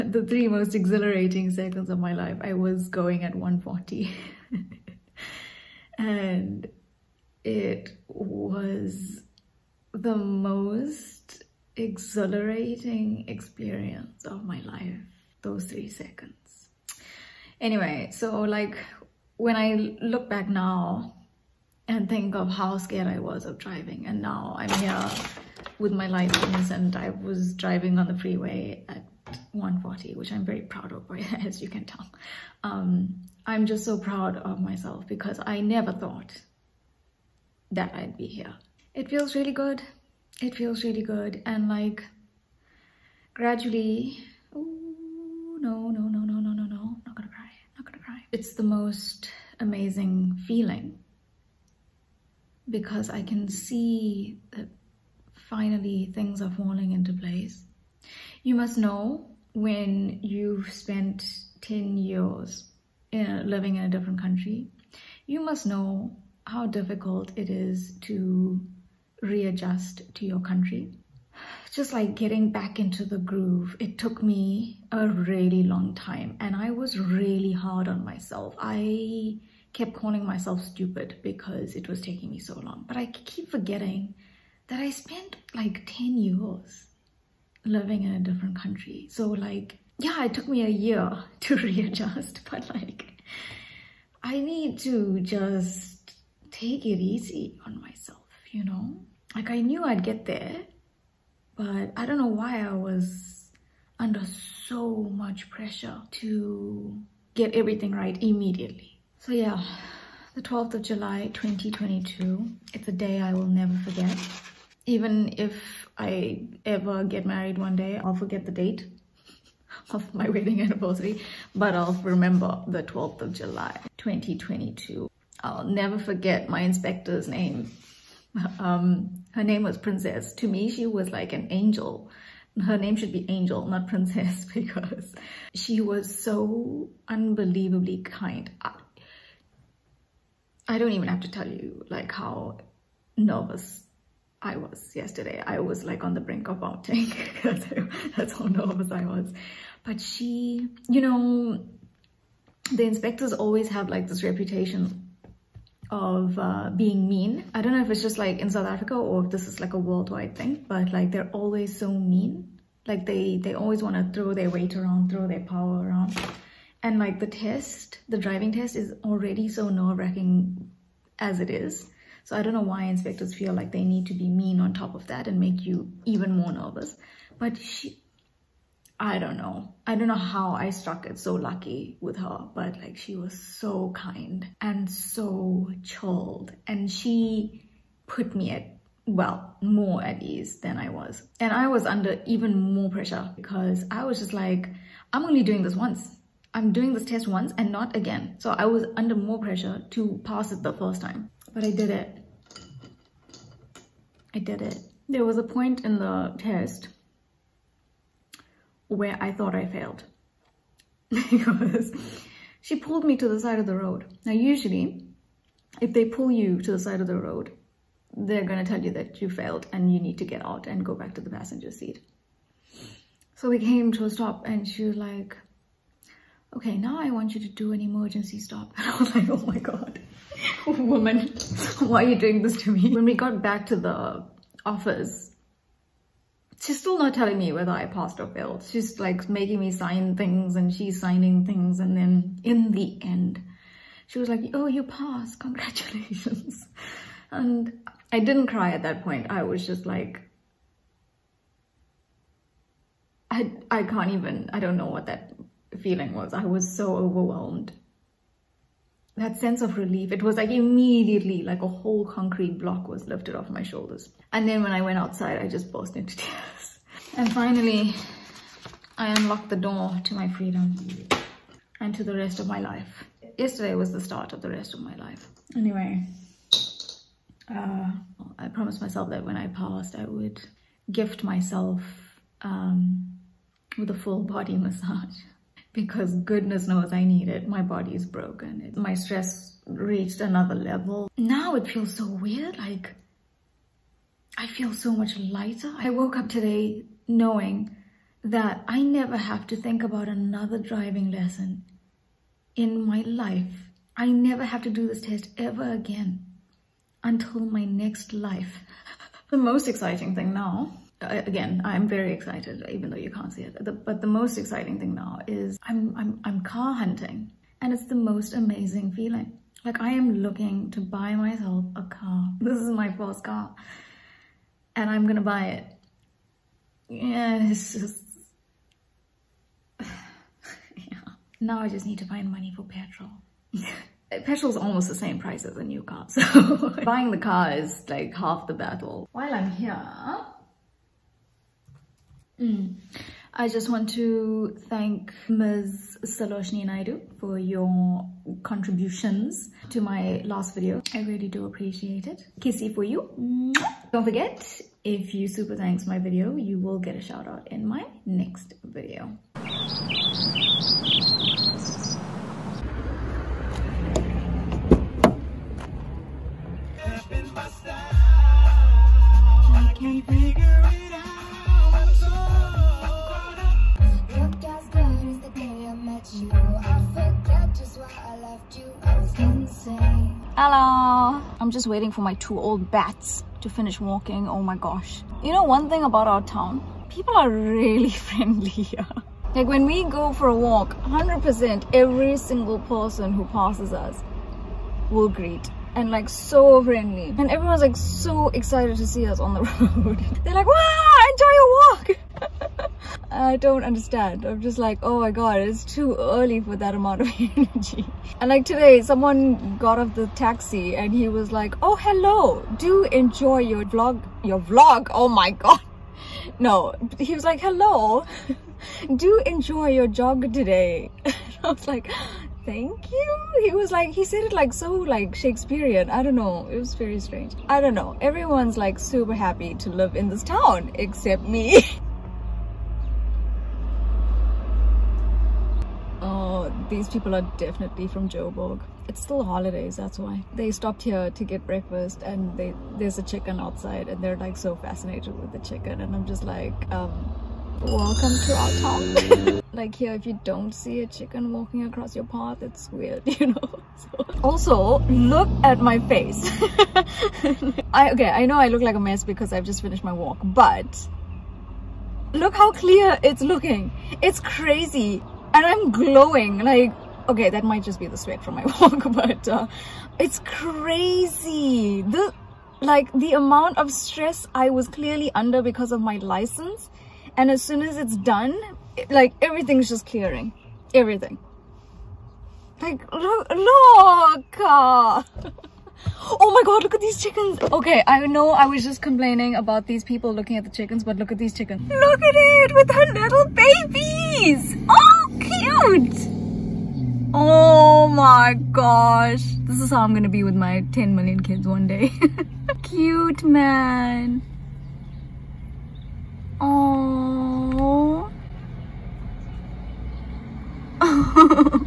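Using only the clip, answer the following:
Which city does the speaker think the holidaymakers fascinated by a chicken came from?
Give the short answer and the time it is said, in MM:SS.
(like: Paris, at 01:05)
Joburg, at 07:18.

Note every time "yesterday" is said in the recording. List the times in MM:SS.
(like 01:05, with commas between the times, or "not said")
02:24, 04:33.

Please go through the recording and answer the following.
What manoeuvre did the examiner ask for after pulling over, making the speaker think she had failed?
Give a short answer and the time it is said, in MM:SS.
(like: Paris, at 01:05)
Emergency stop, at 03:47.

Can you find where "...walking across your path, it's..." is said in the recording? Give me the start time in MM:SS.
07:31.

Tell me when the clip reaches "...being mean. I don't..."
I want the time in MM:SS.
02:36.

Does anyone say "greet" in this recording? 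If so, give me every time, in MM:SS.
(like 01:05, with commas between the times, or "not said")
06:35.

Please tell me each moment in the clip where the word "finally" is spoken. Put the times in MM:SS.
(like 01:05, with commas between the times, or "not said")
00:55, 04:27.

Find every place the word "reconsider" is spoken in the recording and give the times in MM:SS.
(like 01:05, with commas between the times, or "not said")
not said.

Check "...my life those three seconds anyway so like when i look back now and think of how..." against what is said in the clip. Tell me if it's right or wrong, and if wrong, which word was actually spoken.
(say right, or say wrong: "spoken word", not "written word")
right.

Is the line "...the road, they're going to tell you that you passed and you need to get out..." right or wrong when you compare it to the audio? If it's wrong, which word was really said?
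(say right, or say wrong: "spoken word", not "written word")
wrong: "failed", not "passed".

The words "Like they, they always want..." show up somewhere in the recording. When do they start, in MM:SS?
02:42.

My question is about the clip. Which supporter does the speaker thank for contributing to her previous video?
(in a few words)
Saloshni Naidu.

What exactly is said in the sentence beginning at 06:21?
I'm just waiting for my two old bats to finish walking.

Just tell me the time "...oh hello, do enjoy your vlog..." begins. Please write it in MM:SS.
06:51.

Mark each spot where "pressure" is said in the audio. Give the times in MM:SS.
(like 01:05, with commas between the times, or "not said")
01:45, 03:12, 03:19.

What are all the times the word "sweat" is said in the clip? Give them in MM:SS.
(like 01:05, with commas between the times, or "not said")
07:47.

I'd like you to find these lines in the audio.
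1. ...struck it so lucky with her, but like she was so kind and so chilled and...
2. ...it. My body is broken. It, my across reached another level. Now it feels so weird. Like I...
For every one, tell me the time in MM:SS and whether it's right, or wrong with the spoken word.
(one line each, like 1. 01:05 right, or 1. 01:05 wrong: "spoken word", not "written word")
1. 03:00 right
2. 04:47 wrong: "stress", not "across".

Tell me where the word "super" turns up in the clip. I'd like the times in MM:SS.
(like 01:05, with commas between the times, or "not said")
05:55, 07:08.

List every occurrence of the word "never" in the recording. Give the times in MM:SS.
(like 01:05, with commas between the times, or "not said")
00:35, 01:53, 02:05, 04:58, 05:04.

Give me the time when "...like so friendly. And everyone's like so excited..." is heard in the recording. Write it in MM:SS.
06:35.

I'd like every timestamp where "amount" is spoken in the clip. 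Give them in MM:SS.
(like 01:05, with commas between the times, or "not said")
06:46, 07:53.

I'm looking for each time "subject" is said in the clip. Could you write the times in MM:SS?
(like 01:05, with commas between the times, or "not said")
not said.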